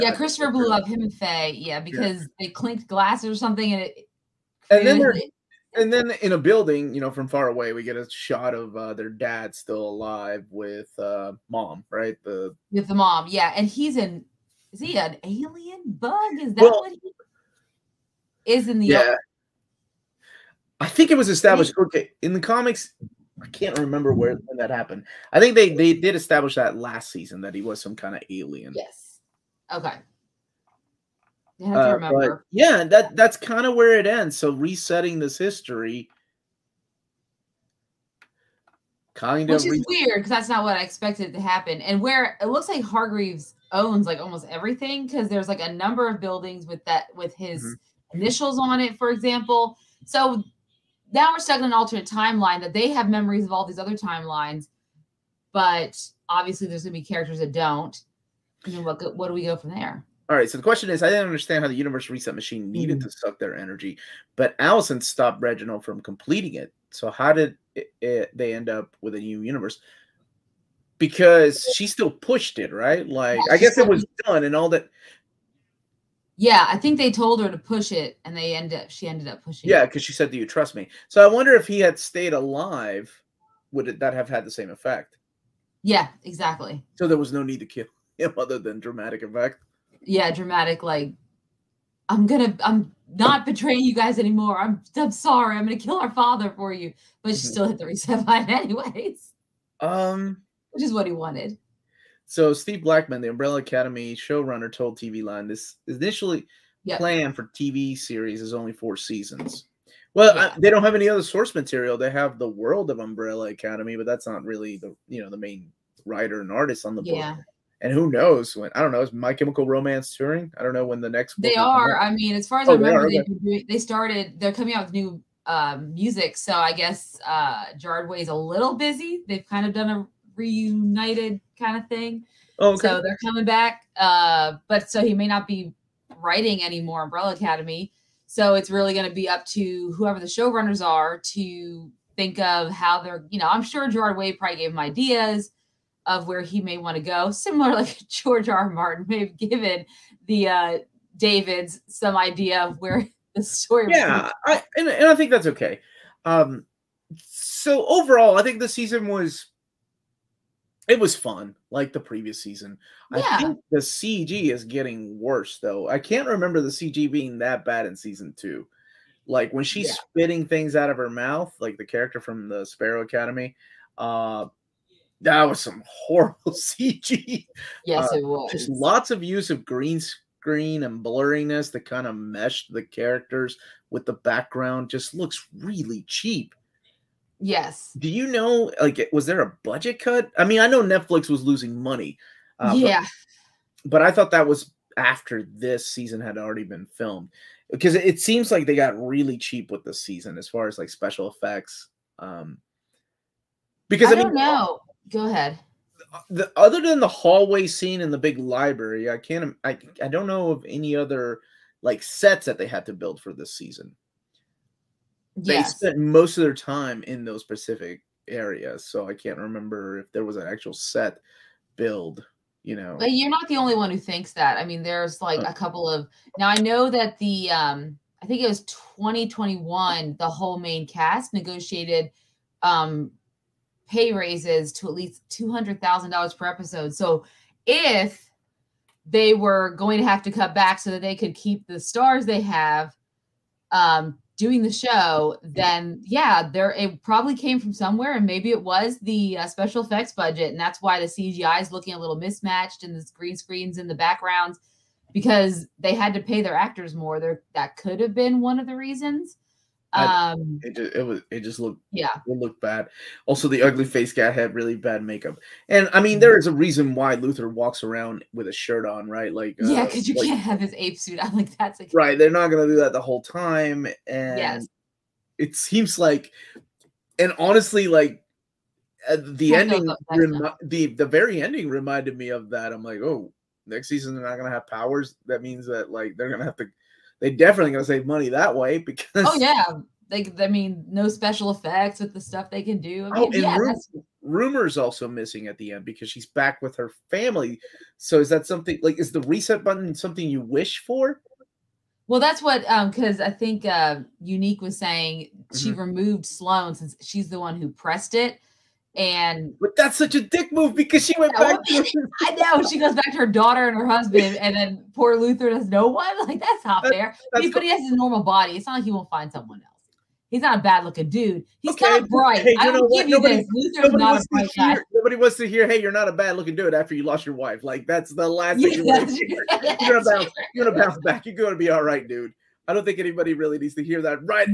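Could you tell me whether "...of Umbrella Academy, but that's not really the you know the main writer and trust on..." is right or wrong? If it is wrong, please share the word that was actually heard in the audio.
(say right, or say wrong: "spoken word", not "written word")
wrong: "artist", not "trust".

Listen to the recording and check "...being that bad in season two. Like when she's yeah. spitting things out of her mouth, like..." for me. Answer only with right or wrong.
right.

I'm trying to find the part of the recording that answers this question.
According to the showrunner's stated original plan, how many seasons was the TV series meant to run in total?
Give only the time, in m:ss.
1:48.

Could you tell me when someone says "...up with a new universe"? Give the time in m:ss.
1:08.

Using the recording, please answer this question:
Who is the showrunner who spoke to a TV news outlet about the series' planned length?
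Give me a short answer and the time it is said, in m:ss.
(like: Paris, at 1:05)
Steve Blackman, at 1:42.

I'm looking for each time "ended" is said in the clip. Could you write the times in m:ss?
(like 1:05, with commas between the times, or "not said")
1:19.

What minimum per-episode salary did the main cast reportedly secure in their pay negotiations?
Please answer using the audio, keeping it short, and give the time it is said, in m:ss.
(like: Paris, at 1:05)
$200,000, at 3:55.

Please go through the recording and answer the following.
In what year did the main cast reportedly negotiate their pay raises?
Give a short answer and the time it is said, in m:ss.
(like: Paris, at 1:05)
2021, at 3:48.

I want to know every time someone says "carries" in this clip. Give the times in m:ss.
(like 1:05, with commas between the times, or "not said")
not said.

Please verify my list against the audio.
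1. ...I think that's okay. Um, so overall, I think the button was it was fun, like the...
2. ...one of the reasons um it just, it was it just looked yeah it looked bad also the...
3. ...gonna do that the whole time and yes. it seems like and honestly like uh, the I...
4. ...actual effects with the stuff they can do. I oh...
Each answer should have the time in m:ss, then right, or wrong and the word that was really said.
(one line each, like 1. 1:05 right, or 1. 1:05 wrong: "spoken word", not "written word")
1. 2:35 wrong: "season", not "button"
2. 4:18 right
3. 4:32 right
4. 4:51 wrong: "special", not "actual".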